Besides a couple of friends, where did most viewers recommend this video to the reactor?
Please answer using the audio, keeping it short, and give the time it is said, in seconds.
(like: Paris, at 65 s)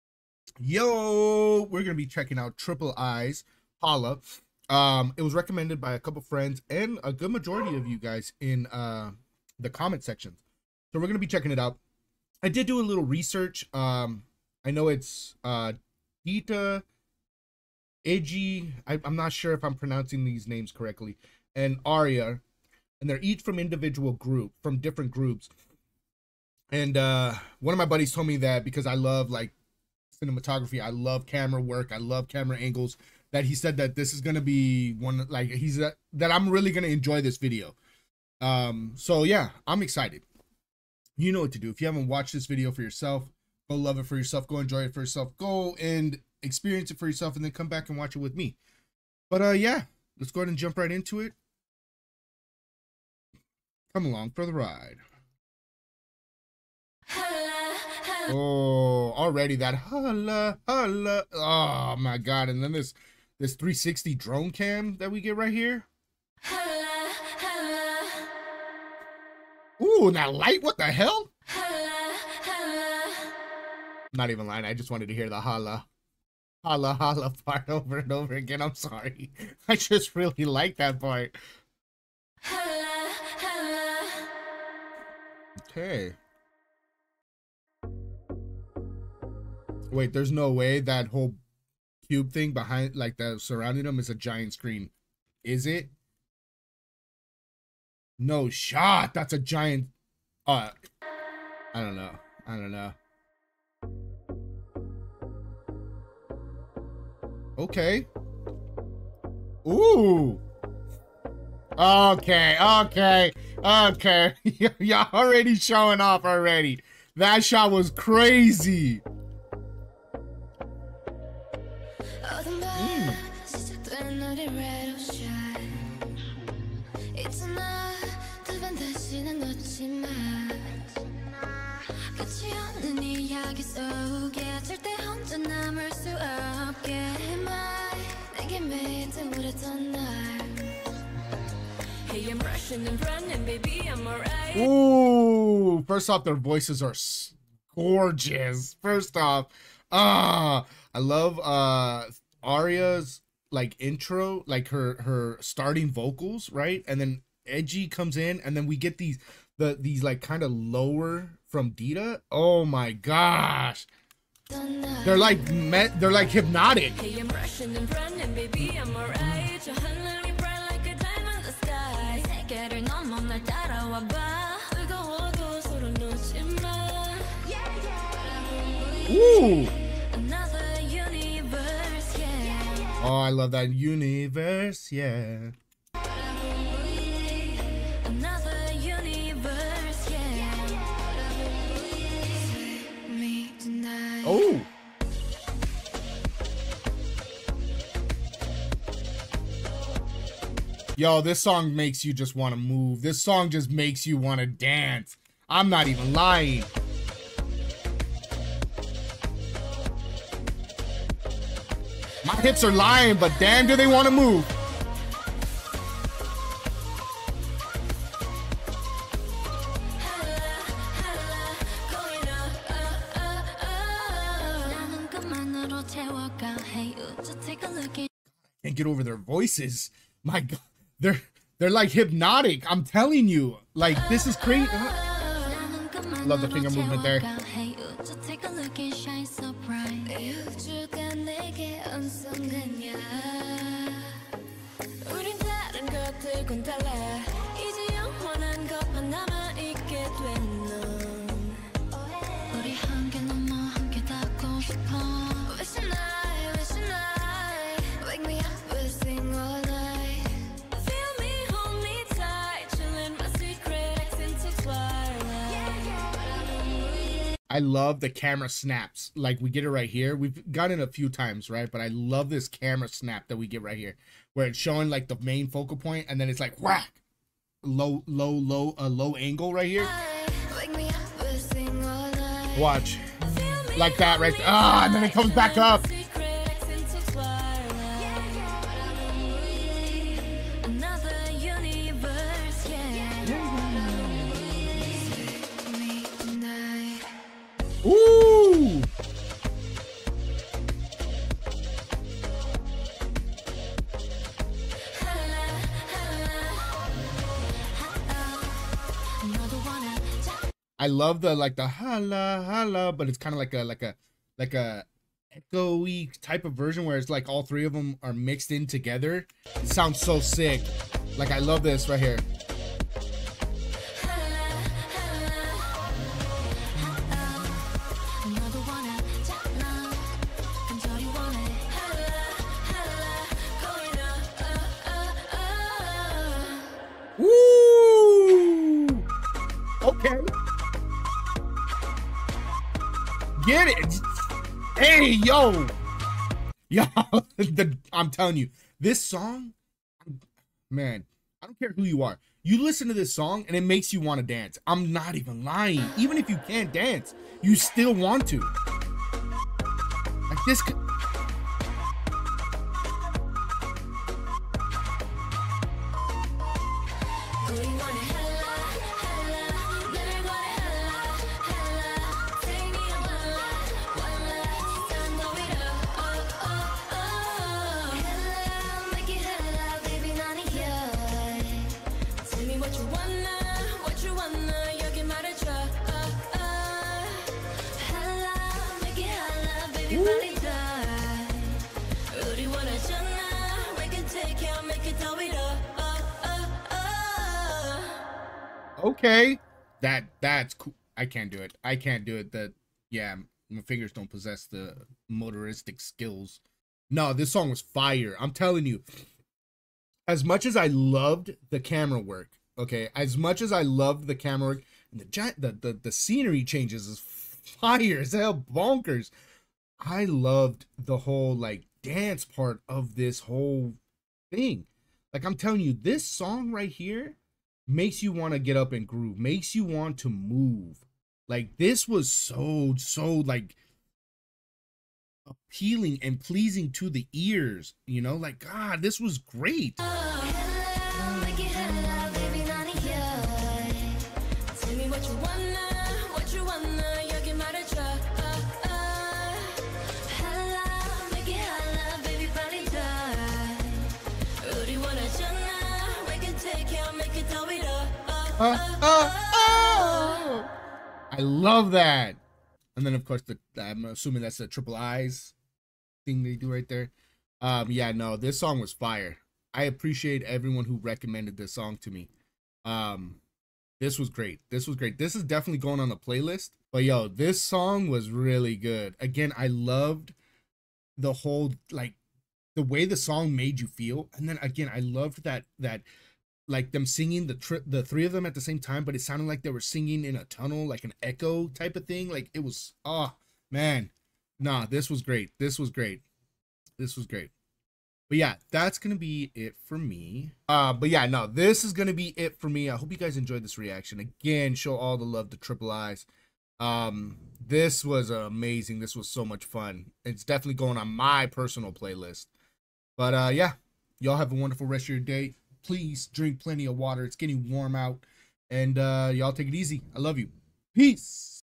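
comment sections, at 9 s.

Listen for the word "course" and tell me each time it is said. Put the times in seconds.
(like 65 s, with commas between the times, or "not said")
463 s.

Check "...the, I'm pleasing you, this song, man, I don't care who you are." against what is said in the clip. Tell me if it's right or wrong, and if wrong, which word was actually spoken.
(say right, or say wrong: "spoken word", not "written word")
wrong: "telling", not "pleasing".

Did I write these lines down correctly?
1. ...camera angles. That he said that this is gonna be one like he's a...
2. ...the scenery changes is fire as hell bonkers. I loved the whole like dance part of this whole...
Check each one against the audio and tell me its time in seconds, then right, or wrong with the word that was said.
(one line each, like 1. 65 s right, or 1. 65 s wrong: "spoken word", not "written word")
1. 32 s right
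2. 415 s right.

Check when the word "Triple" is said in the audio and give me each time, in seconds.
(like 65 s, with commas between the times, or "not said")
2 s, 464 s, 505 s.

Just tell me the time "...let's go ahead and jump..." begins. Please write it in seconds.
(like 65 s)
50 s.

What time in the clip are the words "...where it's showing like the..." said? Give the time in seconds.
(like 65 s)
274 s.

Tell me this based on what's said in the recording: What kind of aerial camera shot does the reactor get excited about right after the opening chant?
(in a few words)
360 drone cam.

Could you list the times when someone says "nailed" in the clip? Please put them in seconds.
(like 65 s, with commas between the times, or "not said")
not said.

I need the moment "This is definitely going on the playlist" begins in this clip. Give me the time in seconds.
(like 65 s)
474 s.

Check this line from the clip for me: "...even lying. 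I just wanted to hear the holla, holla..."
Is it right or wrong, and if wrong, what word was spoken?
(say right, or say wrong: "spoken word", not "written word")
right.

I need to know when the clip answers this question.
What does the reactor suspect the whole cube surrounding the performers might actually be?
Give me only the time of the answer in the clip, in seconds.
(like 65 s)
94 s.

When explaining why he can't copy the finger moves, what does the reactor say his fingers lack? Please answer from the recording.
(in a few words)
motoristic skills.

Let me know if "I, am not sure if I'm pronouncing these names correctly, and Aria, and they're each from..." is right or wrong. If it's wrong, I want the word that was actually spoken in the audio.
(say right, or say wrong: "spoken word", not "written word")
right.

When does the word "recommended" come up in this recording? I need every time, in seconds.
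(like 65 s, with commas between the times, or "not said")
5 s, 470 s.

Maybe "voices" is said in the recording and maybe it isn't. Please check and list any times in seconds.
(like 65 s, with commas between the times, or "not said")
146 s, 229 s.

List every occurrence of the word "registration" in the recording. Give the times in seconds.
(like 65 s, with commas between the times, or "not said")
not said.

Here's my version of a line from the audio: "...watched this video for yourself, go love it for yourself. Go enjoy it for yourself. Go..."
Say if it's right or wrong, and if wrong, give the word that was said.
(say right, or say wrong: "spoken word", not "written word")
right.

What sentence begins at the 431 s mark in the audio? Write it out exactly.
Like this was so so like appealing and pleasing to the ears, you know?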